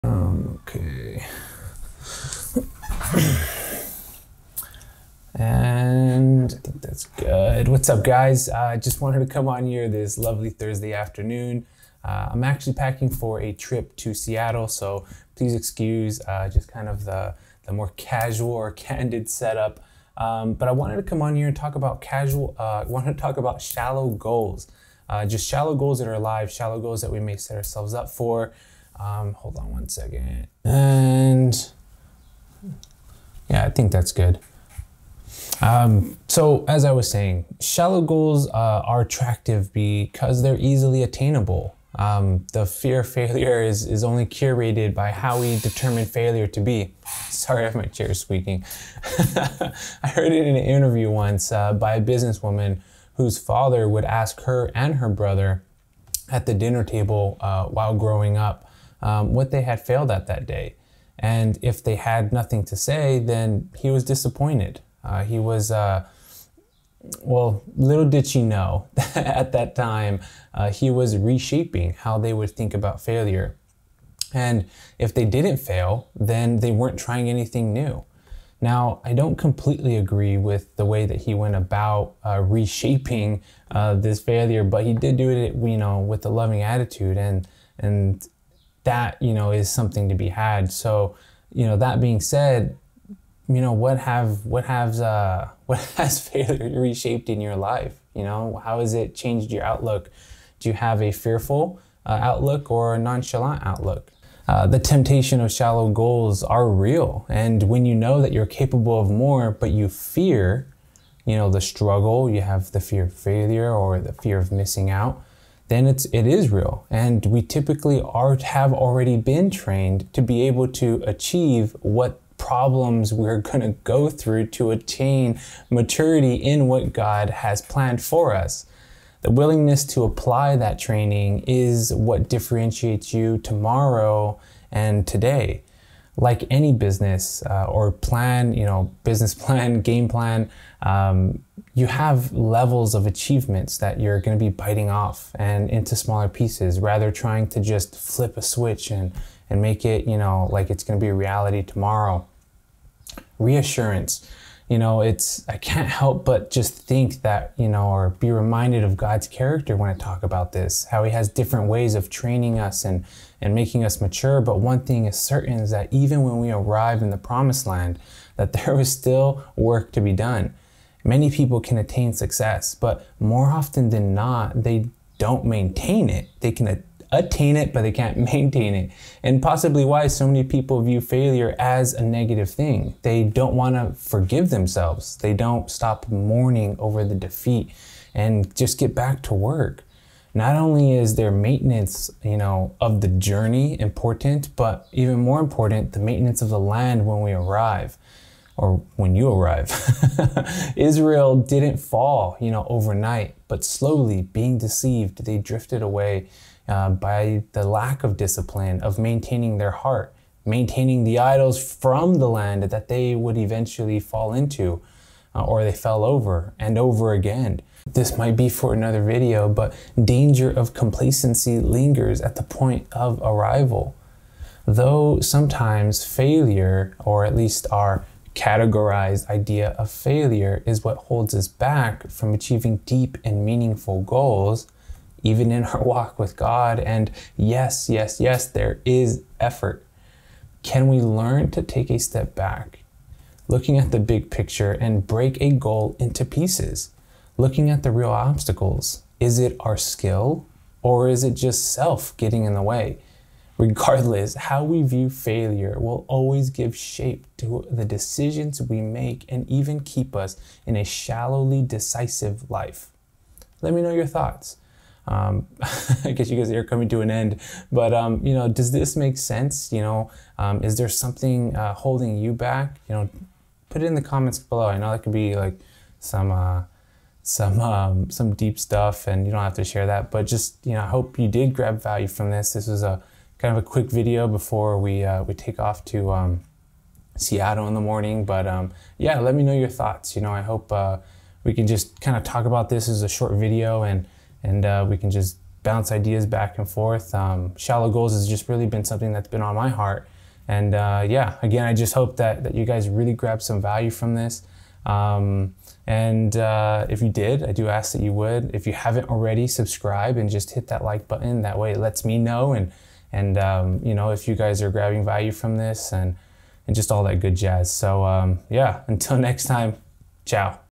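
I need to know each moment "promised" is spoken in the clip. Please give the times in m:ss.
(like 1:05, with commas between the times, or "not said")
2:47.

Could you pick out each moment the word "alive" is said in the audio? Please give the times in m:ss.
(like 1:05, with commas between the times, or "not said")
0:26.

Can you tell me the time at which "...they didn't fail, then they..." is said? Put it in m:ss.
1:15.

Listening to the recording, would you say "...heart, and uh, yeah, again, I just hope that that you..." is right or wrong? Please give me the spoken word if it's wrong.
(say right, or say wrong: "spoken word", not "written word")
right.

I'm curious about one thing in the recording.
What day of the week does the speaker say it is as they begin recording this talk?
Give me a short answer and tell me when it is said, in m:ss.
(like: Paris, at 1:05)
Thursday, at 0:10.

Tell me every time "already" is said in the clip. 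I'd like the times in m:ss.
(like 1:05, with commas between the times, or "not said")
1:58, 5:09.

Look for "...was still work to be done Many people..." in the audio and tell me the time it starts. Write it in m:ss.
2:48.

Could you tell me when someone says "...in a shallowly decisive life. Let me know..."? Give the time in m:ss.
4:20.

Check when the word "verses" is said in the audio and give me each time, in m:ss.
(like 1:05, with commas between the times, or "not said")
not said.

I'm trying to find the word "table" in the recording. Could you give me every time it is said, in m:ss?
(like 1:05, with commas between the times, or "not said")
0:56.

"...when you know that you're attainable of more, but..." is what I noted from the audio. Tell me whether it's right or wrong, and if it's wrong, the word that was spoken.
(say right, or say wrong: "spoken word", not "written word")
wrong: "capable", not "attainable".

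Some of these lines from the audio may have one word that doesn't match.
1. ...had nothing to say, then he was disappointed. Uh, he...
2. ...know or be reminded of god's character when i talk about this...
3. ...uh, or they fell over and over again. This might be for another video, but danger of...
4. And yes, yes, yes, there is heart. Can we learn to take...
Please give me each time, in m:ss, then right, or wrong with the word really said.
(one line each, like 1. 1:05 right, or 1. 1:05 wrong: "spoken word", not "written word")
1. 1:01 right
2. 2:37 right
3. 3:35 right
4. 3:56 wrong: "effort", not "heart".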